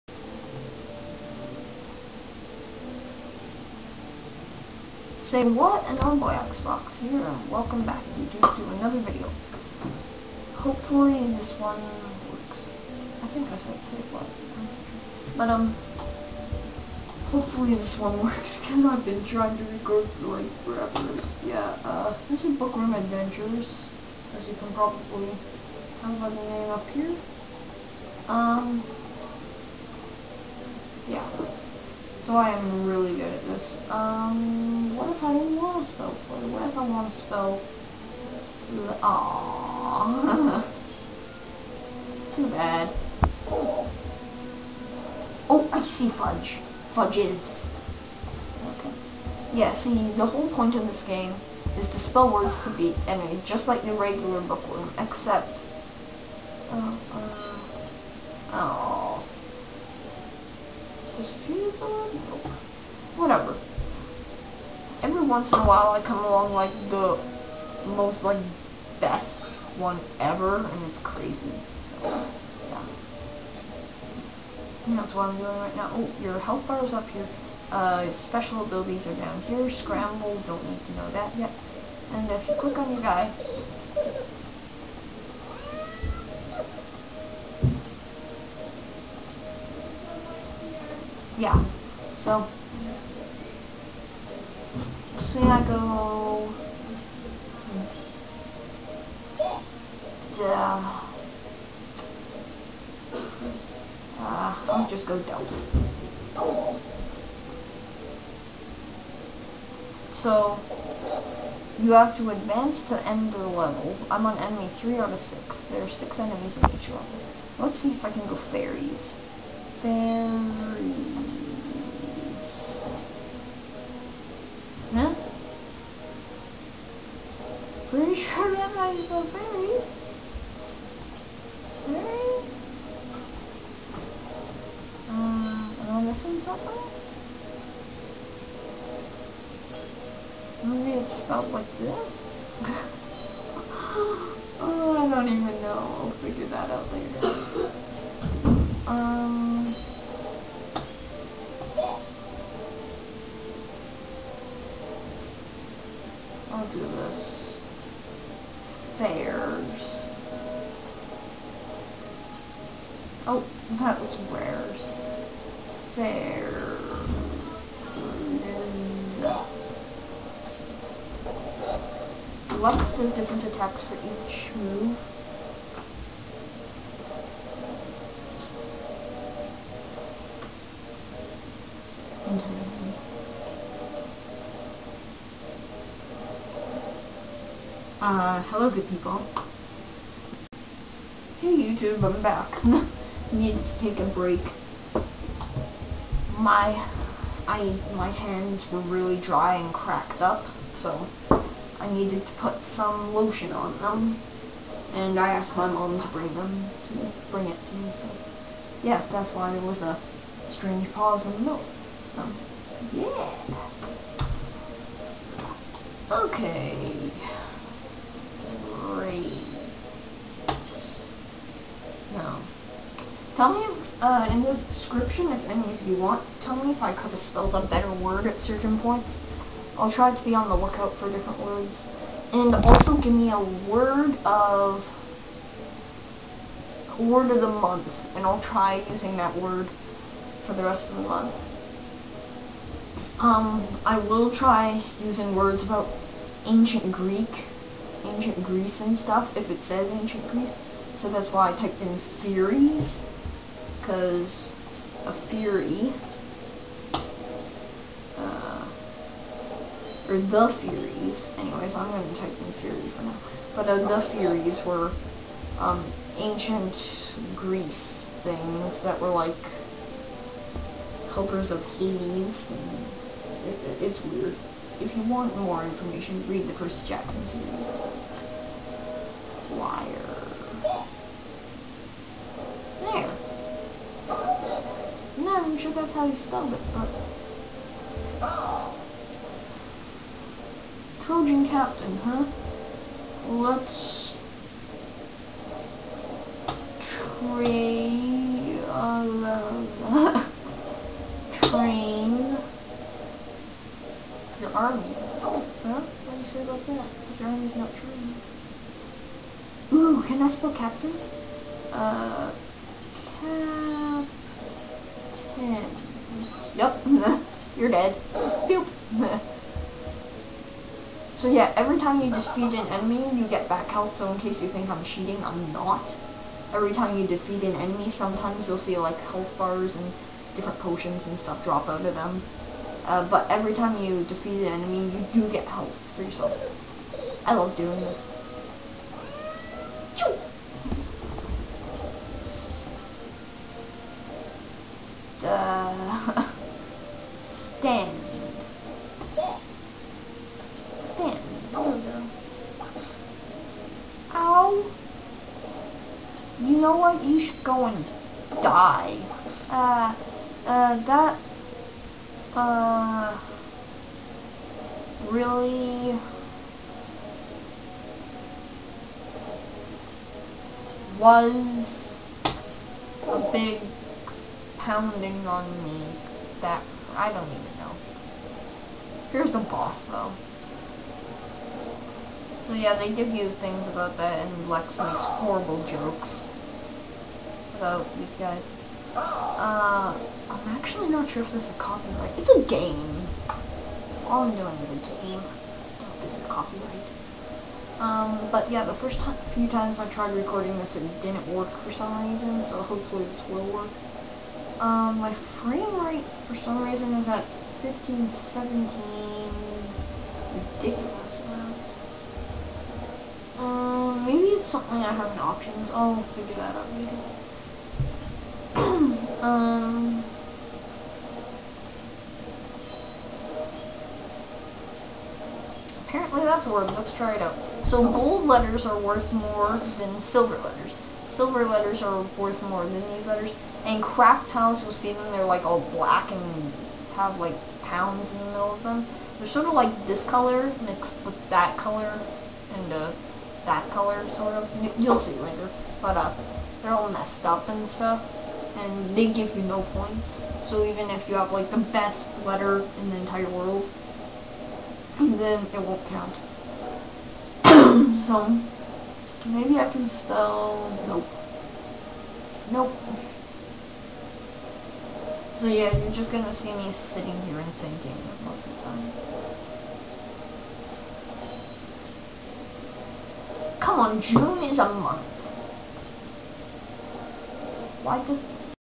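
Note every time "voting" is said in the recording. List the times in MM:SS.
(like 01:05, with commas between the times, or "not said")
not said.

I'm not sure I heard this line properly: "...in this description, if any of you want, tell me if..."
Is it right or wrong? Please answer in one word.
right.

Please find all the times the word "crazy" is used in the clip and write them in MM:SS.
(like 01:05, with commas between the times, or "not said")
01:10.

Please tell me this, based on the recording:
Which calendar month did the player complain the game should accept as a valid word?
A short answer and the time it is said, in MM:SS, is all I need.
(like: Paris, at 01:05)
June, at 07:54.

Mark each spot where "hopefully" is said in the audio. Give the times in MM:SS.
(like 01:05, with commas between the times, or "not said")
00:10, 00:17, 06:42.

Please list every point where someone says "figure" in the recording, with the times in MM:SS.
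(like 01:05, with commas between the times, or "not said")
02:26, 06:56.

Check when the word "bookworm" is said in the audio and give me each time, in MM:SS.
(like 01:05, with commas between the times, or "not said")
00:22, 00:54.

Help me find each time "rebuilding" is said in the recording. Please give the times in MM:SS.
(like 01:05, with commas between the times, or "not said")
not said.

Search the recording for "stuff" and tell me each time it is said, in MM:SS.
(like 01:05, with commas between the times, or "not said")
04:08, 05:31, 07:27.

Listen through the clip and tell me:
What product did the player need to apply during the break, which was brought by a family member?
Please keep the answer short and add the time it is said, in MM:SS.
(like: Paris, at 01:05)
lotion, at 03:23.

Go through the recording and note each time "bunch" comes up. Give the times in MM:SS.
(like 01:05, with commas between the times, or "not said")
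not said.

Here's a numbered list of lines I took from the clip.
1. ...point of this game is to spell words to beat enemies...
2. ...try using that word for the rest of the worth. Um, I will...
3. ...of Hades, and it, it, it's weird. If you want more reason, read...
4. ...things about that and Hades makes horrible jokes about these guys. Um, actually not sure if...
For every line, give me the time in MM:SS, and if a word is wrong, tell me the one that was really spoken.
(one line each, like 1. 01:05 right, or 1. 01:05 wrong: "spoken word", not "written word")
1. 00:50 right
2. 03:58 wrong: "month", not "worth"
3. 04:31 wrong: "information", not "reason"
4. 06:23 wrong: "Lex", not "Hades".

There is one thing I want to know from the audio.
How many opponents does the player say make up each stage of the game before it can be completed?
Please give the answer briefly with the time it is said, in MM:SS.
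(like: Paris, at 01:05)
6, at 01:55.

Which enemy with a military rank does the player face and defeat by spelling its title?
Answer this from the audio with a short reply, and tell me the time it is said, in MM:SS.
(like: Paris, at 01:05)
Trojan Captain, at 04:51.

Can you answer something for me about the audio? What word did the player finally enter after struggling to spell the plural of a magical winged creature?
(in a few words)
delta.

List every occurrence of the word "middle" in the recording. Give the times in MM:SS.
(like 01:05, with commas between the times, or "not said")
03:31, 07:18.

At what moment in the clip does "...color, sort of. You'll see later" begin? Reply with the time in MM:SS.
07:23.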